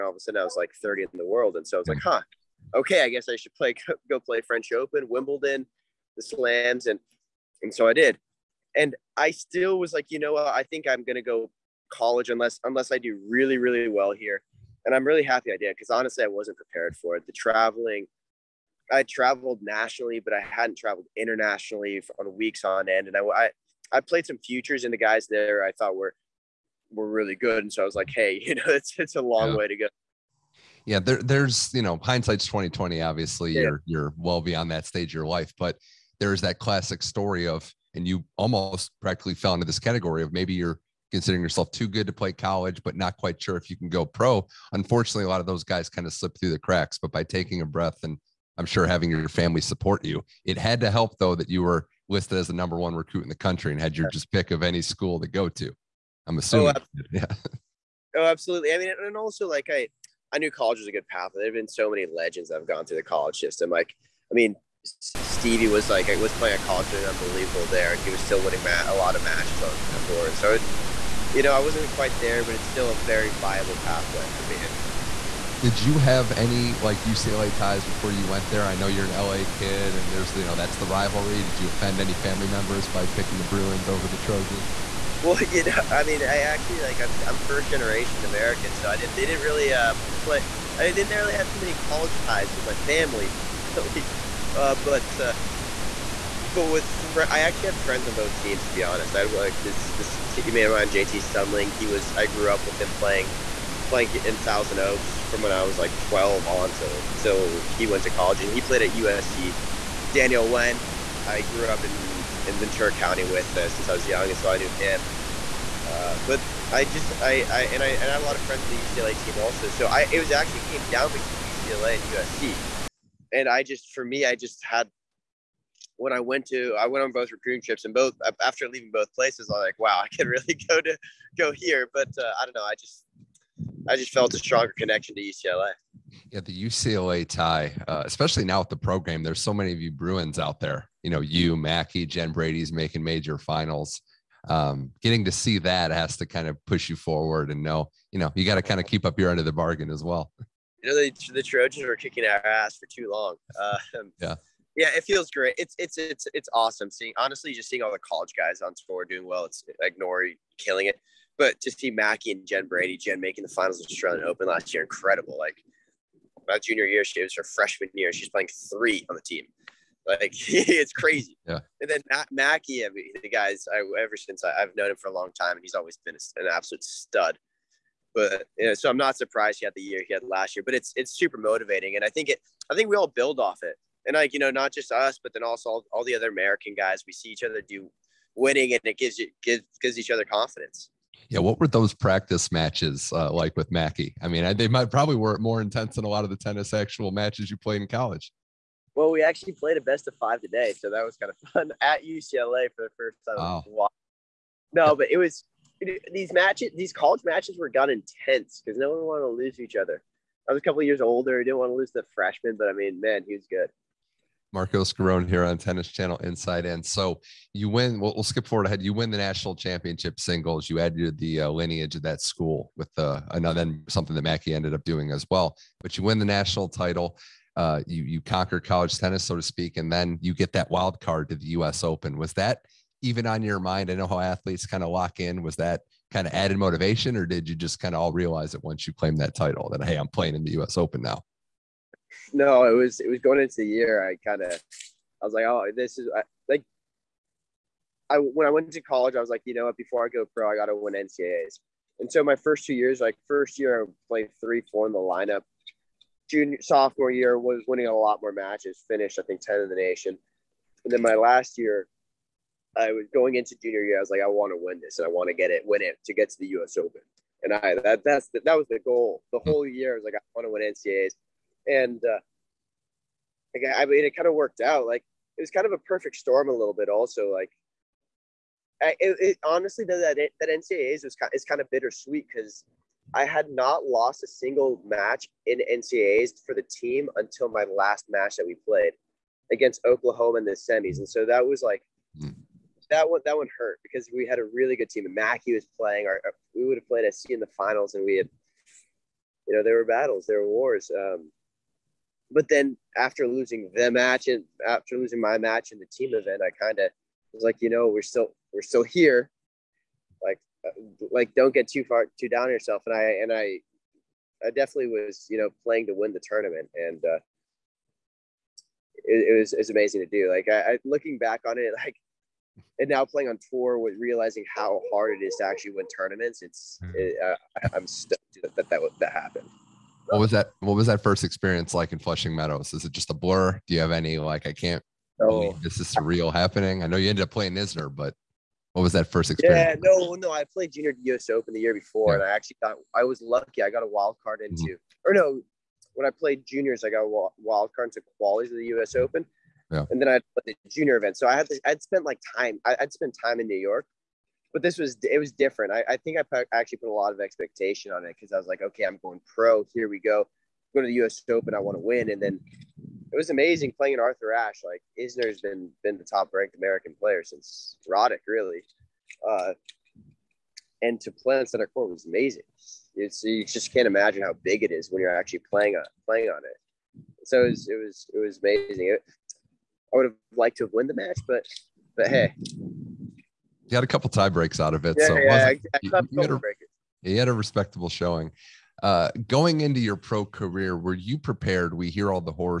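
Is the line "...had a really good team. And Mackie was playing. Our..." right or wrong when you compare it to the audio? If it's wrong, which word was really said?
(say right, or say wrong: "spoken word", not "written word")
right.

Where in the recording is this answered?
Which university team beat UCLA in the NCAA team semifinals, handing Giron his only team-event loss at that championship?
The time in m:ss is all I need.
4:49.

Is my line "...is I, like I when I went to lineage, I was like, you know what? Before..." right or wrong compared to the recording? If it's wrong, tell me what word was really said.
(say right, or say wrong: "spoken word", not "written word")
wrong: "college", not "lineage".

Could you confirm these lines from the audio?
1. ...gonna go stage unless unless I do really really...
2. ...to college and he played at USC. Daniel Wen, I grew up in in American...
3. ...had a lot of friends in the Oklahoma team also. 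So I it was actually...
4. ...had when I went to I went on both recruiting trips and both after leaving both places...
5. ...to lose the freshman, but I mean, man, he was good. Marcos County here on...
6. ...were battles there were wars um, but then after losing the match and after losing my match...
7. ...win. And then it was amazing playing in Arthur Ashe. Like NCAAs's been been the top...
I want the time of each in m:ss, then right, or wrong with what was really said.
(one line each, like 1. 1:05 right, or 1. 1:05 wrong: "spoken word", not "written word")
1. 0:11 wrong: "college", not "stage"
2. 1:48 wrong: "Ventura", not "American"
3. 1:58 wrong: "UCLA", not "Oklahoma"
4. 2:04 right
5. 3:31 wrong: "Giron", not "County"
6. 4:59 right
7. 6:01 wrong: "Isner", not "NCAAs".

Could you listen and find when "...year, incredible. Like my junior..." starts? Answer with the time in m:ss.
2:44.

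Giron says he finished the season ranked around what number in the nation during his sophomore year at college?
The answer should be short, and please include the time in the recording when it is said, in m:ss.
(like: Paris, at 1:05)
10, at 4:19.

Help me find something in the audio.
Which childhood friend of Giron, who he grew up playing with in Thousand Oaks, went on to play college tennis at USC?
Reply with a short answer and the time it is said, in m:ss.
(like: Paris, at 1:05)
JT Sundling, at 1:40.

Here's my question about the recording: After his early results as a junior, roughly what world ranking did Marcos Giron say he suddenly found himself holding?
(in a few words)
30th.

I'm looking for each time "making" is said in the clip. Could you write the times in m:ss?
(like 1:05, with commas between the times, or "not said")
2:22, 2:43.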